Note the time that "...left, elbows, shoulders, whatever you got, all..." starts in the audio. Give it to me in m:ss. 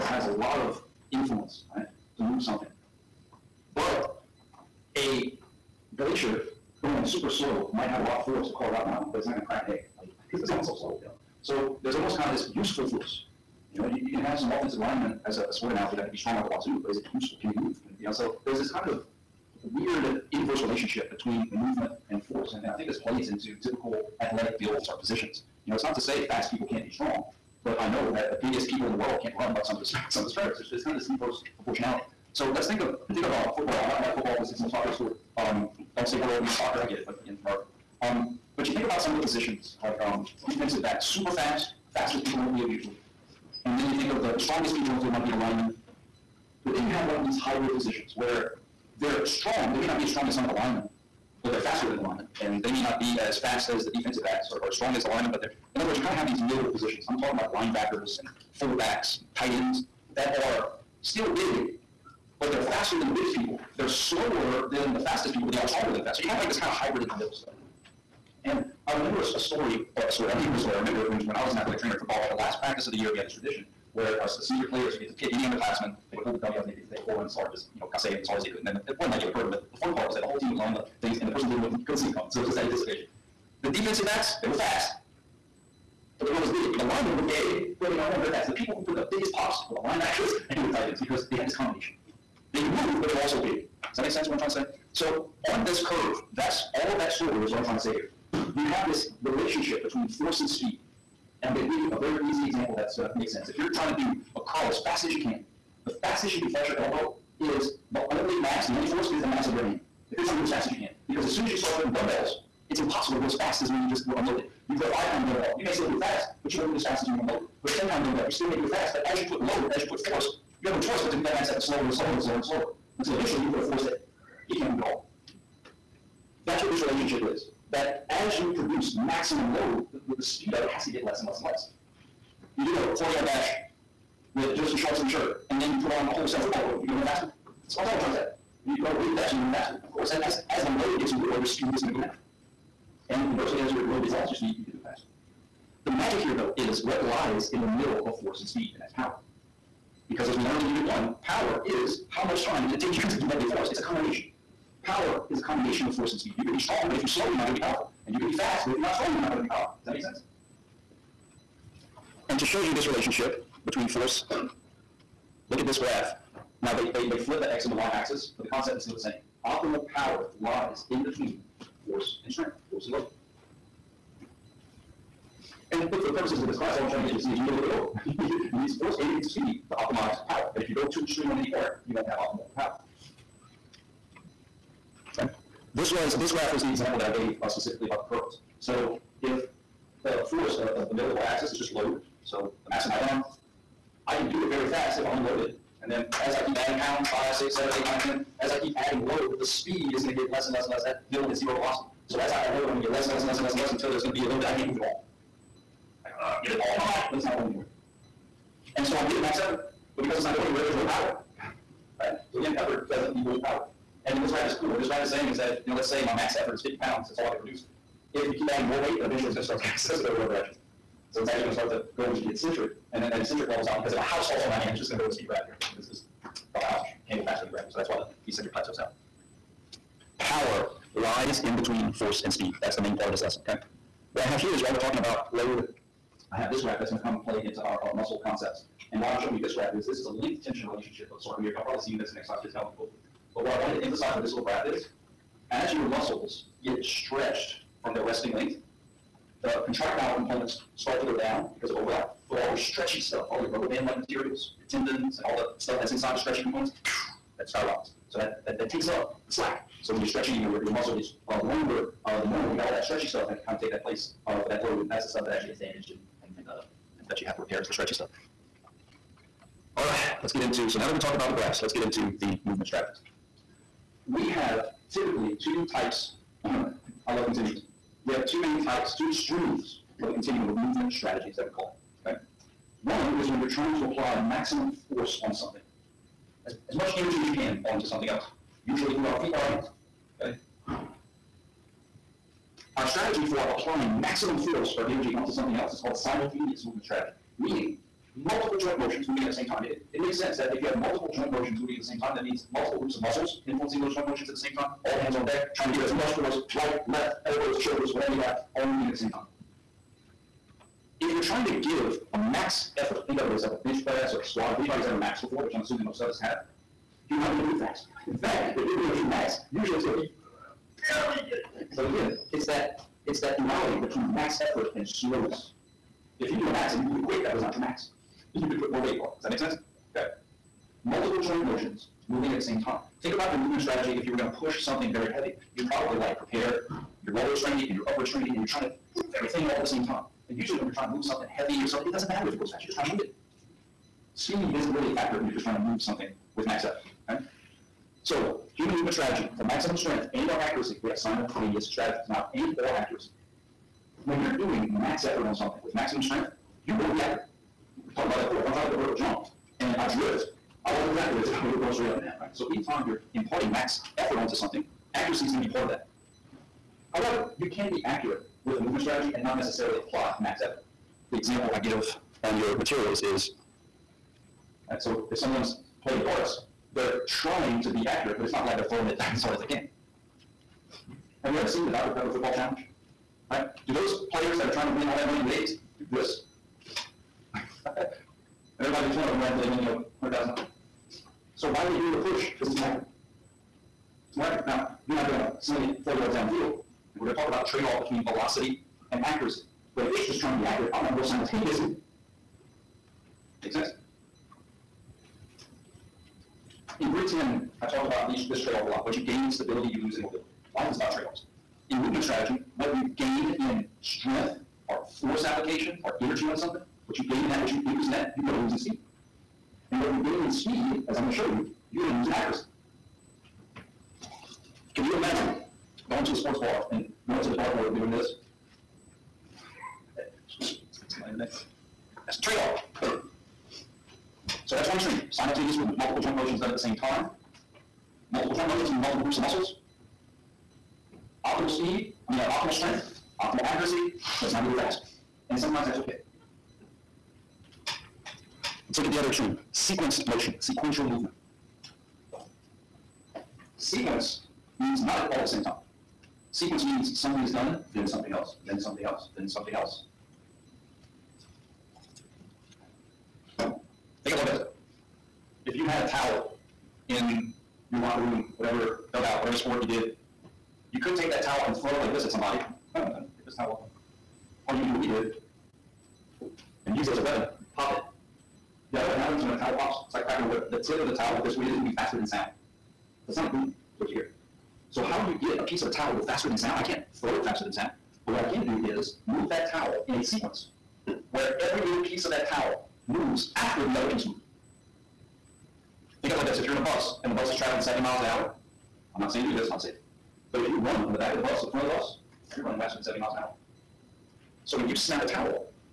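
5:06.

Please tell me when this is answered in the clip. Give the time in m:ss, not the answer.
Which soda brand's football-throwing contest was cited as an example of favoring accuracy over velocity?
6:21.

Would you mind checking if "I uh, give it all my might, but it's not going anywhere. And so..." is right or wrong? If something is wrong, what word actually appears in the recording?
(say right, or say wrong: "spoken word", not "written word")
right.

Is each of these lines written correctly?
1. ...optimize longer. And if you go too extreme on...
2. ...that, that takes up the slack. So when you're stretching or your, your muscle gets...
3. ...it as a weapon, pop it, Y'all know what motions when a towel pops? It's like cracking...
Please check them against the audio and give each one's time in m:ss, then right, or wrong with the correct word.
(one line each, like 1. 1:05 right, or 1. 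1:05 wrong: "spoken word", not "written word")
1. 2:59 wrong: "power", not "longer"
2. 4:18 right
3. 7:56 wrong: "happens", not "motions".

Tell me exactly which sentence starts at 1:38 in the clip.
You have this relationship between force and speed.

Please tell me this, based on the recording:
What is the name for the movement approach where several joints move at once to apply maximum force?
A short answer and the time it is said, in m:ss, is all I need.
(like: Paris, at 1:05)
simultaneous movement strategy, at 4:55.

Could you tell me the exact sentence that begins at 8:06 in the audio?
I can't throw it faster than sound.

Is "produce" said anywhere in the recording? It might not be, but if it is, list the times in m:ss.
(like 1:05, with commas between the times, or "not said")
2:08, 3:37.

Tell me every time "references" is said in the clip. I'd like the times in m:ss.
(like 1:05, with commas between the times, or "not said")
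not said.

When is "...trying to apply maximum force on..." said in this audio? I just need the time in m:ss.
4:43.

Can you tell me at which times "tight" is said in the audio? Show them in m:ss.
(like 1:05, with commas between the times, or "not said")
0:59, 1:30.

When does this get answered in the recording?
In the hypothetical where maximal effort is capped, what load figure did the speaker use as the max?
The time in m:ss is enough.
3:36.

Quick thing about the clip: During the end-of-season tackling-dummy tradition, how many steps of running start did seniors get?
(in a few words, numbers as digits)
4.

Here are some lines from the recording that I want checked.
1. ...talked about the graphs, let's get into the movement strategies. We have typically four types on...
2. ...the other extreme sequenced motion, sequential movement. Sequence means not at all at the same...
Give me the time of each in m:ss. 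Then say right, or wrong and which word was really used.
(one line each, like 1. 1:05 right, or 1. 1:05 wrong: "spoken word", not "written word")
1. 4:30 wrong: "two", not "four"
2. 7:28 right.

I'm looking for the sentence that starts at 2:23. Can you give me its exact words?
And inversely, as your load gets less, your speed you can go faster.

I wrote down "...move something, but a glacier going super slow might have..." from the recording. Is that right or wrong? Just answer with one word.
right.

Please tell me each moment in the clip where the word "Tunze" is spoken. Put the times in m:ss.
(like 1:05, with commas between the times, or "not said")
not said.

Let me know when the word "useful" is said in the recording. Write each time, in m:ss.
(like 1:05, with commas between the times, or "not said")
0:12, 0:17.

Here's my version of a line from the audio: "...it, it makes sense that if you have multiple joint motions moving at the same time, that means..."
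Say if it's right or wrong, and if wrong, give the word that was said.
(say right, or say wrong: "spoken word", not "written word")
right.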